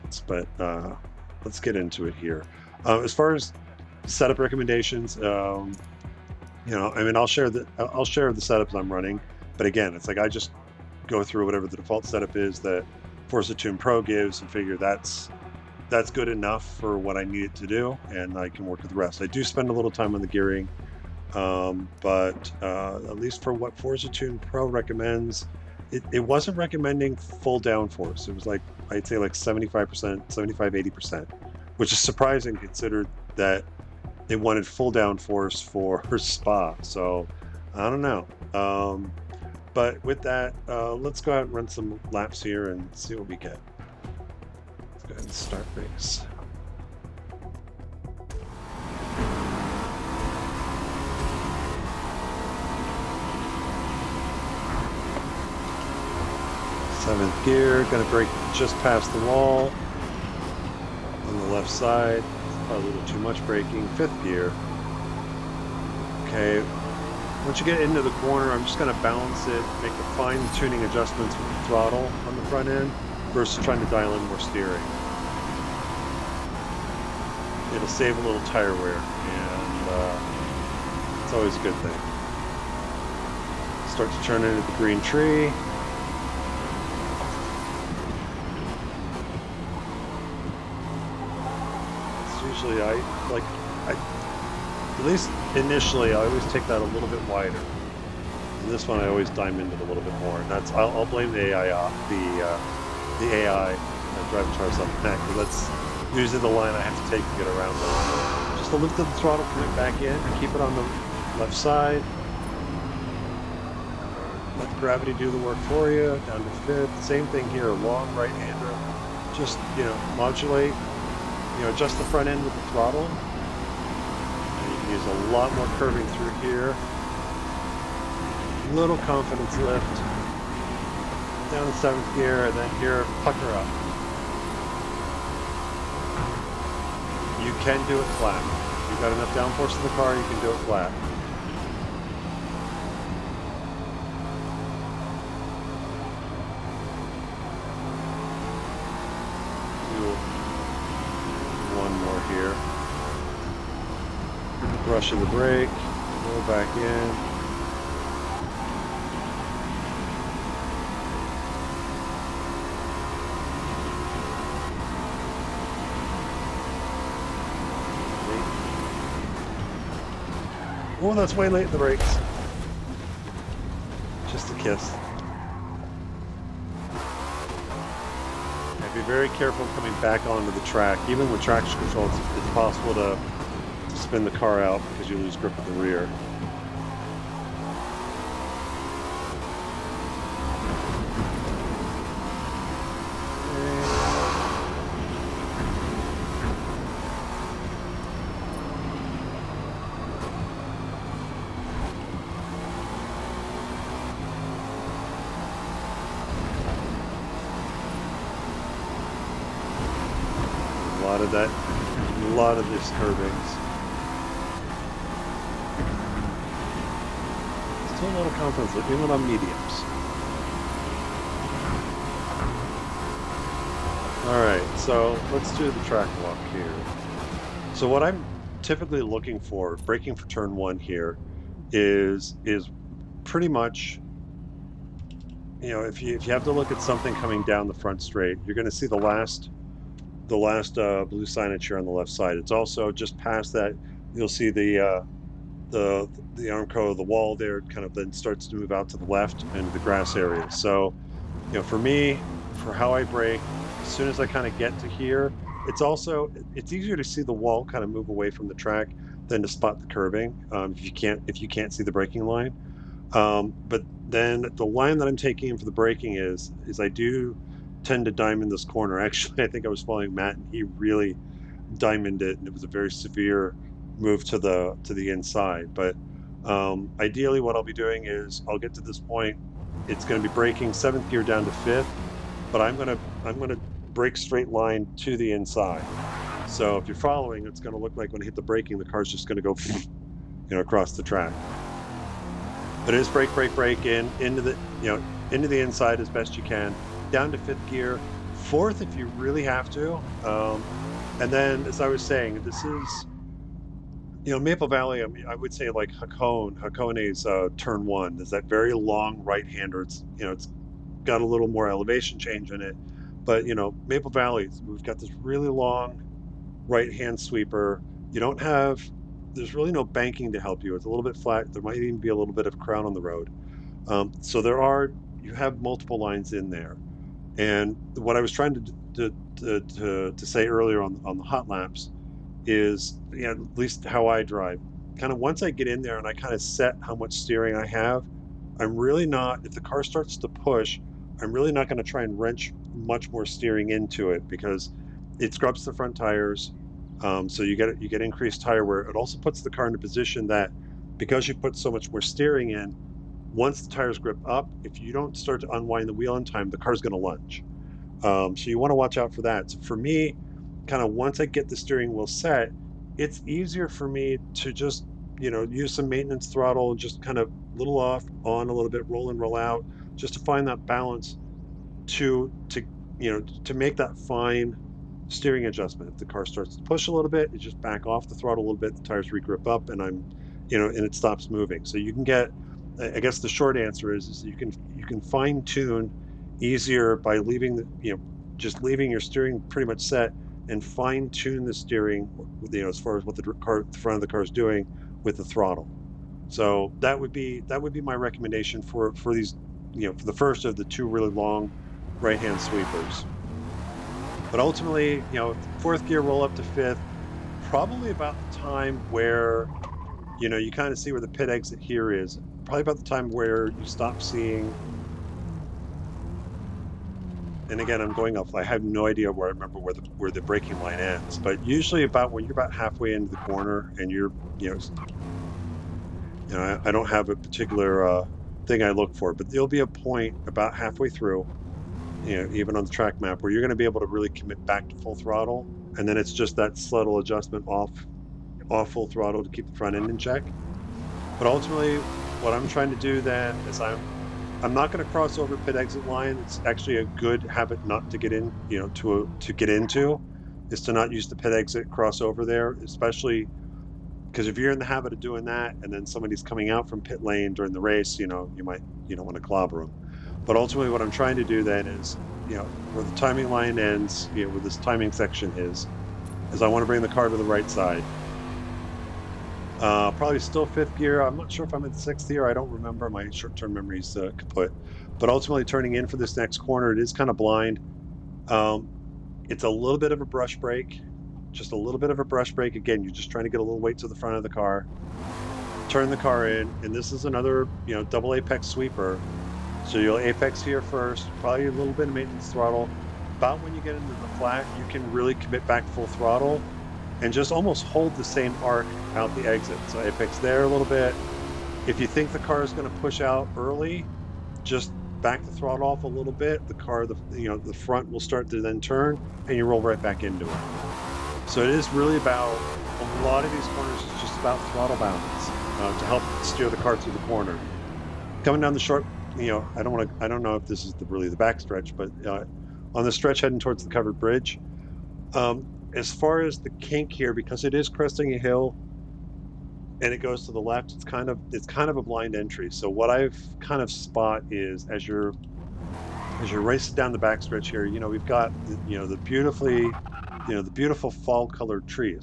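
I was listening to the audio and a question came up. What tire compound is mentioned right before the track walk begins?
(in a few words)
Mediums.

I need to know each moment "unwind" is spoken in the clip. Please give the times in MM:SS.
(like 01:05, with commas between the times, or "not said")
05:55.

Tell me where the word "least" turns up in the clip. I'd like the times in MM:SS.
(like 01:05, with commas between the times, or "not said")
00:23, 01:35, 05:33.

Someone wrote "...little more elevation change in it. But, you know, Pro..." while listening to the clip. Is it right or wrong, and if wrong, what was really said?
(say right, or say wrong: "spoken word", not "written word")
wrong: "Maple", not "Pro".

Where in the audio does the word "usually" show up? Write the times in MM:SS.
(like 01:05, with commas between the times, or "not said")
01:46, 07:01.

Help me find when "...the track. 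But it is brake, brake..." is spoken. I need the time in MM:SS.
04:50.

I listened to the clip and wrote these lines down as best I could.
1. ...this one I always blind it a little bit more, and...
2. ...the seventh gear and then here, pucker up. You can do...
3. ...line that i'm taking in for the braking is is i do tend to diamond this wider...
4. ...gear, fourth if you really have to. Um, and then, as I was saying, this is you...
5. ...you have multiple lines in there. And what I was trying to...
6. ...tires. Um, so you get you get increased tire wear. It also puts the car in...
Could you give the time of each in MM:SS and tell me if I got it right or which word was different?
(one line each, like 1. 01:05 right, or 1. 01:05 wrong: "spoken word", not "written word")
1. 01:38 wrong: "diamond", not "blind"
2. 02:11 right
3. 04:24 wrong: "corner", not "wider"
4. 04:57 right
5. 05:25 right
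6. 05:45 right.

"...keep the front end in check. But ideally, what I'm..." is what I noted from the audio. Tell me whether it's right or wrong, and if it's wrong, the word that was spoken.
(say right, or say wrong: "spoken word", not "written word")
wrong: "ultimately", not "ideally".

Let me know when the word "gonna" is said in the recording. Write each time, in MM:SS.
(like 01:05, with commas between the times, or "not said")
00:57, 01:08, 03:58.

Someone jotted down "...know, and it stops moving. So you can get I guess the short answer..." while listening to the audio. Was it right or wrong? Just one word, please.
right.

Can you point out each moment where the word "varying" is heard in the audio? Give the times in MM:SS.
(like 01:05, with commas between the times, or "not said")
not said.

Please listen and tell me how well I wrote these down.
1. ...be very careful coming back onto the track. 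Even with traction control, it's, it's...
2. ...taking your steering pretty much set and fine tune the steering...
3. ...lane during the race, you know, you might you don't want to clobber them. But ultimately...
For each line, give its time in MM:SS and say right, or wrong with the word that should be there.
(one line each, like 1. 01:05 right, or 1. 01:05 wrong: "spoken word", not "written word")
1. 02:58 right
2. 06:28 wrong: "leaving", not "taking"
3. 07:37 right.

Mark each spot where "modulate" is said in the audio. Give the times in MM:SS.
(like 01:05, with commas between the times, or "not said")
02:00.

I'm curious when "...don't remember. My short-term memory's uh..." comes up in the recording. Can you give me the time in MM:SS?
07:52.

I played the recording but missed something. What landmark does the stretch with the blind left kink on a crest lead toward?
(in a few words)
Covered bridge.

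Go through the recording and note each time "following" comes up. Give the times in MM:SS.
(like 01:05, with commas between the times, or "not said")
04:29, 04:46.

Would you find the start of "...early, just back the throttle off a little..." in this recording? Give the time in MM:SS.
08:23.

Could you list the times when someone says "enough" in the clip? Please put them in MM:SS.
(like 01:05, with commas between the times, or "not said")
00:16, 02:19.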